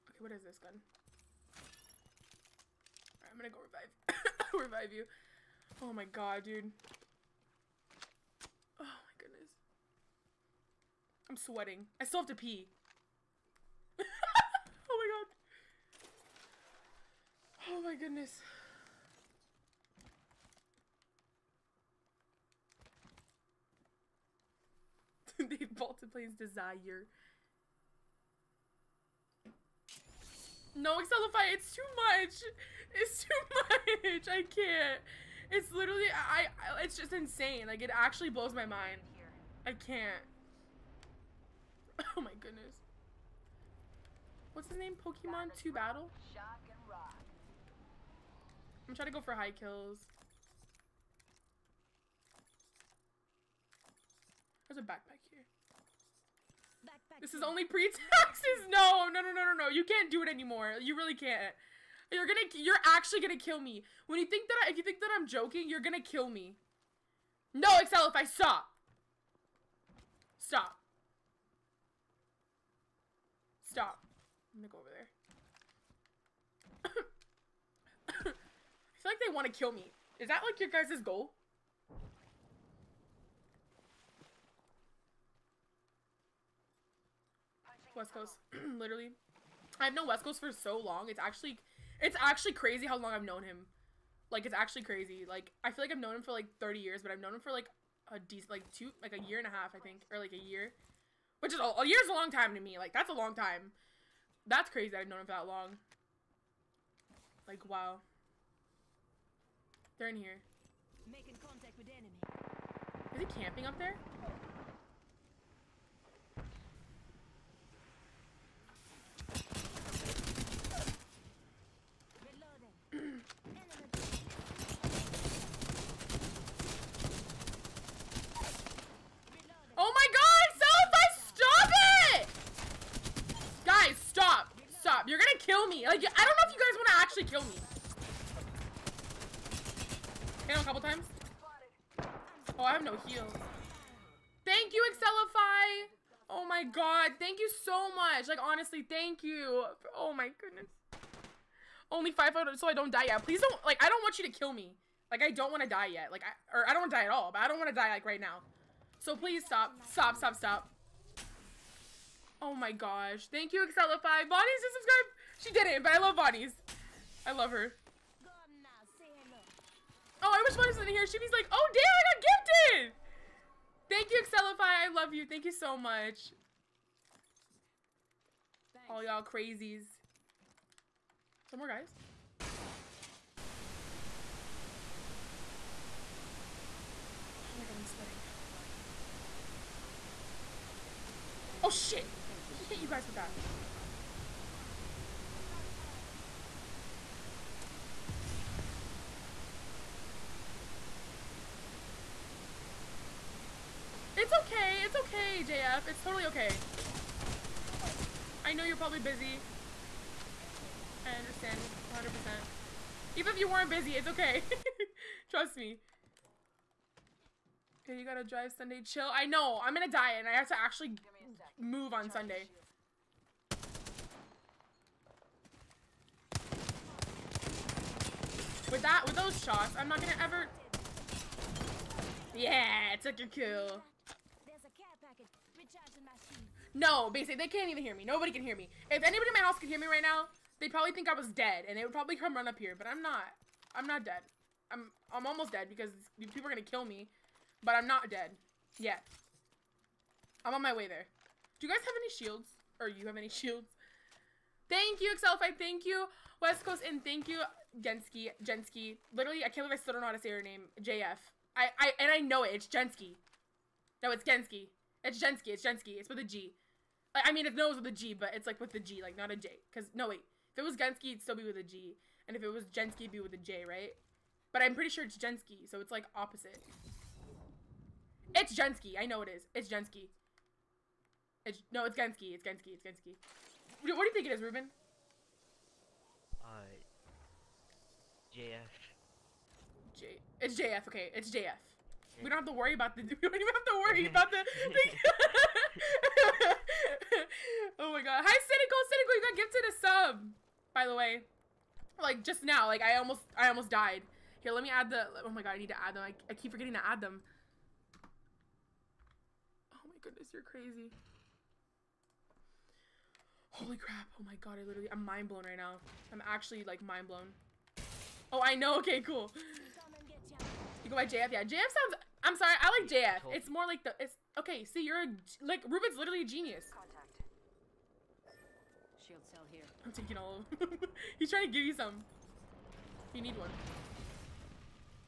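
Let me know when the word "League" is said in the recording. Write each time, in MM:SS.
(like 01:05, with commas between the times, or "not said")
not said.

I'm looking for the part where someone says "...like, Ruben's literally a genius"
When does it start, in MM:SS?
05:25.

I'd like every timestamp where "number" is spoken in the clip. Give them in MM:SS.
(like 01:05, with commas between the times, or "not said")
not said.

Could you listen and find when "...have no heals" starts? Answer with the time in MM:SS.
02:22.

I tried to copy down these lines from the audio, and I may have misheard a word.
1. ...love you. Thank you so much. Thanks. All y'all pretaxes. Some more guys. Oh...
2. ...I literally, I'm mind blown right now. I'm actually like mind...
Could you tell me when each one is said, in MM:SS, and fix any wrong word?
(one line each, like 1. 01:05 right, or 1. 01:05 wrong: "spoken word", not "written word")
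1. 02:54 wrong: "crazies", not "pretaxes"
2. 05:14 right.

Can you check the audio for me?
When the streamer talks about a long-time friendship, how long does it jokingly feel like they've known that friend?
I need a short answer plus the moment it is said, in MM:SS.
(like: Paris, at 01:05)
30 years, at 01:36.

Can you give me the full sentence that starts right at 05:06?
I, I keep forgetting to add them goodness, you're crazy.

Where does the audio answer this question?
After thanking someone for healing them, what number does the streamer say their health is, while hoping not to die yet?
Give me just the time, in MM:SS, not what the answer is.
02:32.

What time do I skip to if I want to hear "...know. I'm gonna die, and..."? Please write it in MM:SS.
03:39.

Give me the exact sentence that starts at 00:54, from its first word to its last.
There's a backpack this is only pre-taxes.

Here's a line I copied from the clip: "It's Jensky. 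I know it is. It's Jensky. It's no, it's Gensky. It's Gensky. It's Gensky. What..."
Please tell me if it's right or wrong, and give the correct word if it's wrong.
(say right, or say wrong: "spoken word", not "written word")
right.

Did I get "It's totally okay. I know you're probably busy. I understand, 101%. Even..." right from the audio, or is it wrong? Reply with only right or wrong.
wrong.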